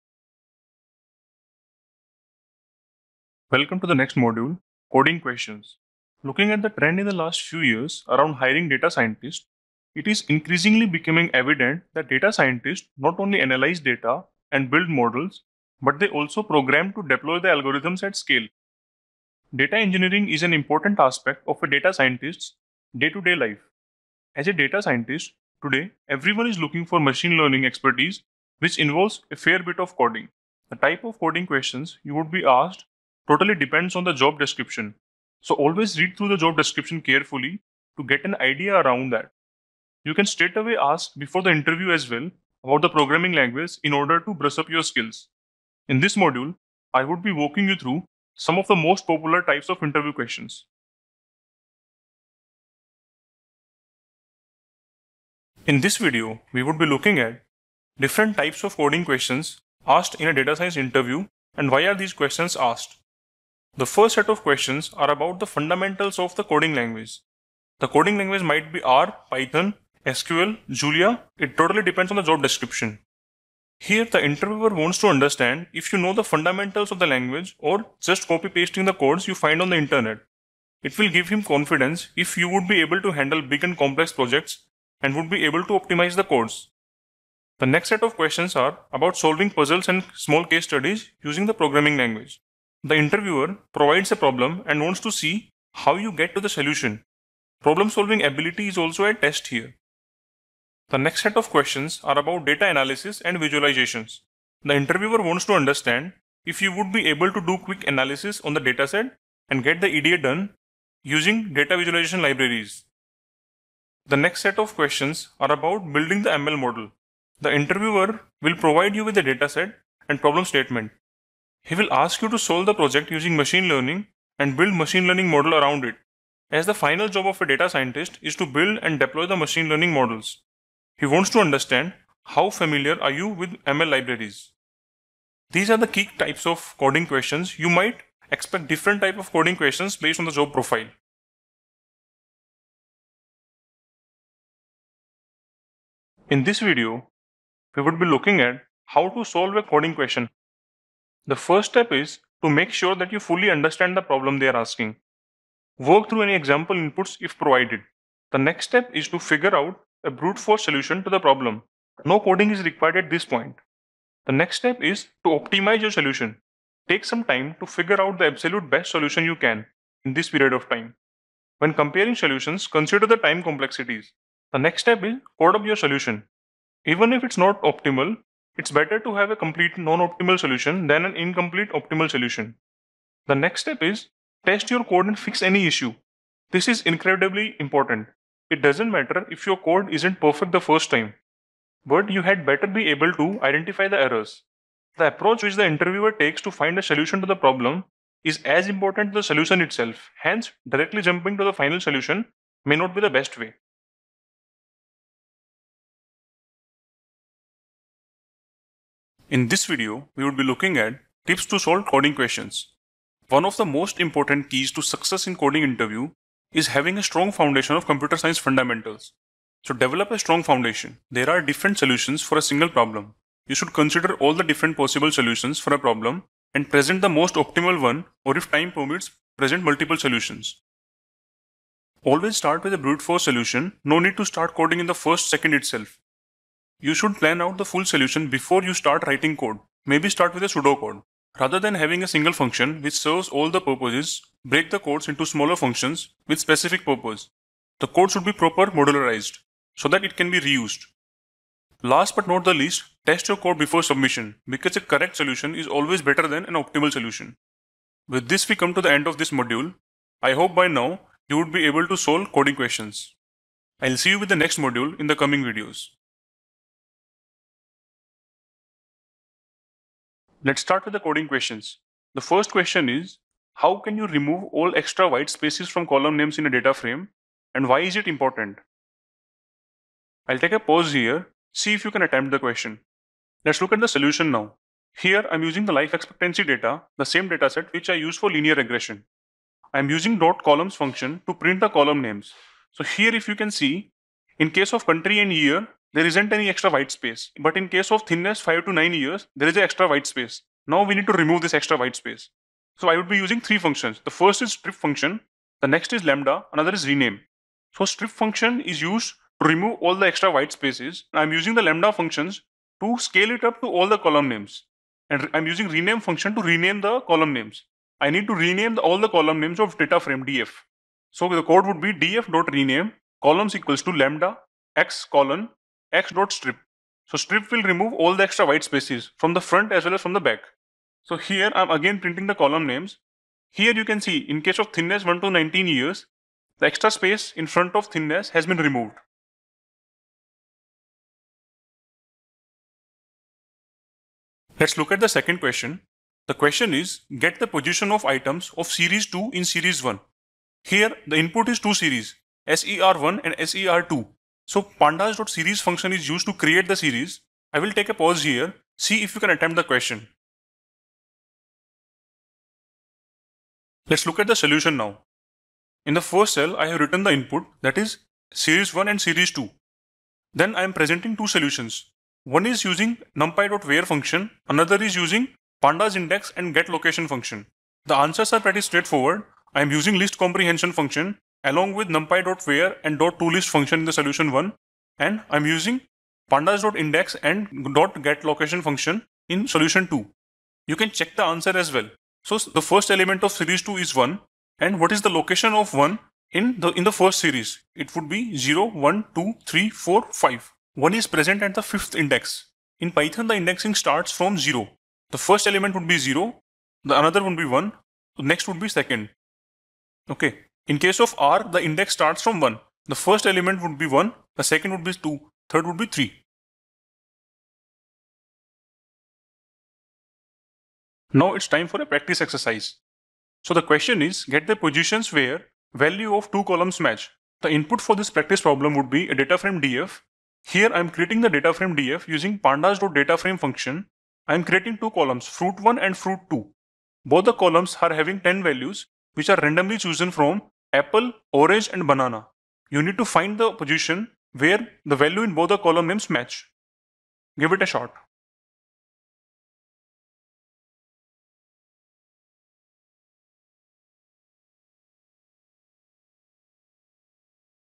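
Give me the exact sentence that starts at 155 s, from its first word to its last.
Work through any example inputs if provided.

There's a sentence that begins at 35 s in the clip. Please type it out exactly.
So always read through the job description carefully to get an idea around that.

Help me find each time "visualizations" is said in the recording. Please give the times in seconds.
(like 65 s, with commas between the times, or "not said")
103 s, 111 s.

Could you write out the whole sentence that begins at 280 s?
I'll take a pause here, see if you can attempt the question.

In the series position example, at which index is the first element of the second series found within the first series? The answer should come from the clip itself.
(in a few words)
5.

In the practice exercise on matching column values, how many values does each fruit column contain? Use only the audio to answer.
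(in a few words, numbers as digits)
10.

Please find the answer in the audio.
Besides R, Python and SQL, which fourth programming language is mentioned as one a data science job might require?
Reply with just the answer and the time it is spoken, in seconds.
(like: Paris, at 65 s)
Julia, at 70 s.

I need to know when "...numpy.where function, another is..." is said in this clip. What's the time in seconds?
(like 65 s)
373 s.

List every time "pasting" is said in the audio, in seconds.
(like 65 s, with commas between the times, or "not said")
78 s.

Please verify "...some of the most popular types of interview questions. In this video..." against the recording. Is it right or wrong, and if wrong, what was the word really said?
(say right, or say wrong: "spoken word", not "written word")
right.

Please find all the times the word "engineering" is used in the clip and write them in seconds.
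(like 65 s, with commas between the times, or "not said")
19 s.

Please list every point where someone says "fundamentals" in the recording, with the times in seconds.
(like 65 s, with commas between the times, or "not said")
65 s, 76 s, 218 s.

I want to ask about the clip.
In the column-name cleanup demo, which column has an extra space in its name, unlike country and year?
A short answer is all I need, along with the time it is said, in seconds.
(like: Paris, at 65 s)
Thinness 5 to 9 years, at 298 s.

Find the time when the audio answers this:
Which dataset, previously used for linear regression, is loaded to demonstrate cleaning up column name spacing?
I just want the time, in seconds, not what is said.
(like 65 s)
285 s.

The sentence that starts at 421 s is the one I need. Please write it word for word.
Now it's time for a practice exercise.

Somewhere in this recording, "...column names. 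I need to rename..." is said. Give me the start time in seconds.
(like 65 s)
317 s.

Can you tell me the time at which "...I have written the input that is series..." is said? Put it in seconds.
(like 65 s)
366 s.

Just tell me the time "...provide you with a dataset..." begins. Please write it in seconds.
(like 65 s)
118 s.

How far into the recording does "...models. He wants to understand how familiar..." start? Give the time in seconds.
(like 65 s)
129 s.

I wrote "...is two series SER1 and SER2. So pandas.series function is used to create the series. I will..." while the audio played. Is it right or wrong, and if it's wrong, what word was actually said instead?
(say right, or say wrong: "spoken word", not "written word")
right.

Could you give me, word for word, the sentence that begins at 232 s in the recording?
Always start with a brute force solution.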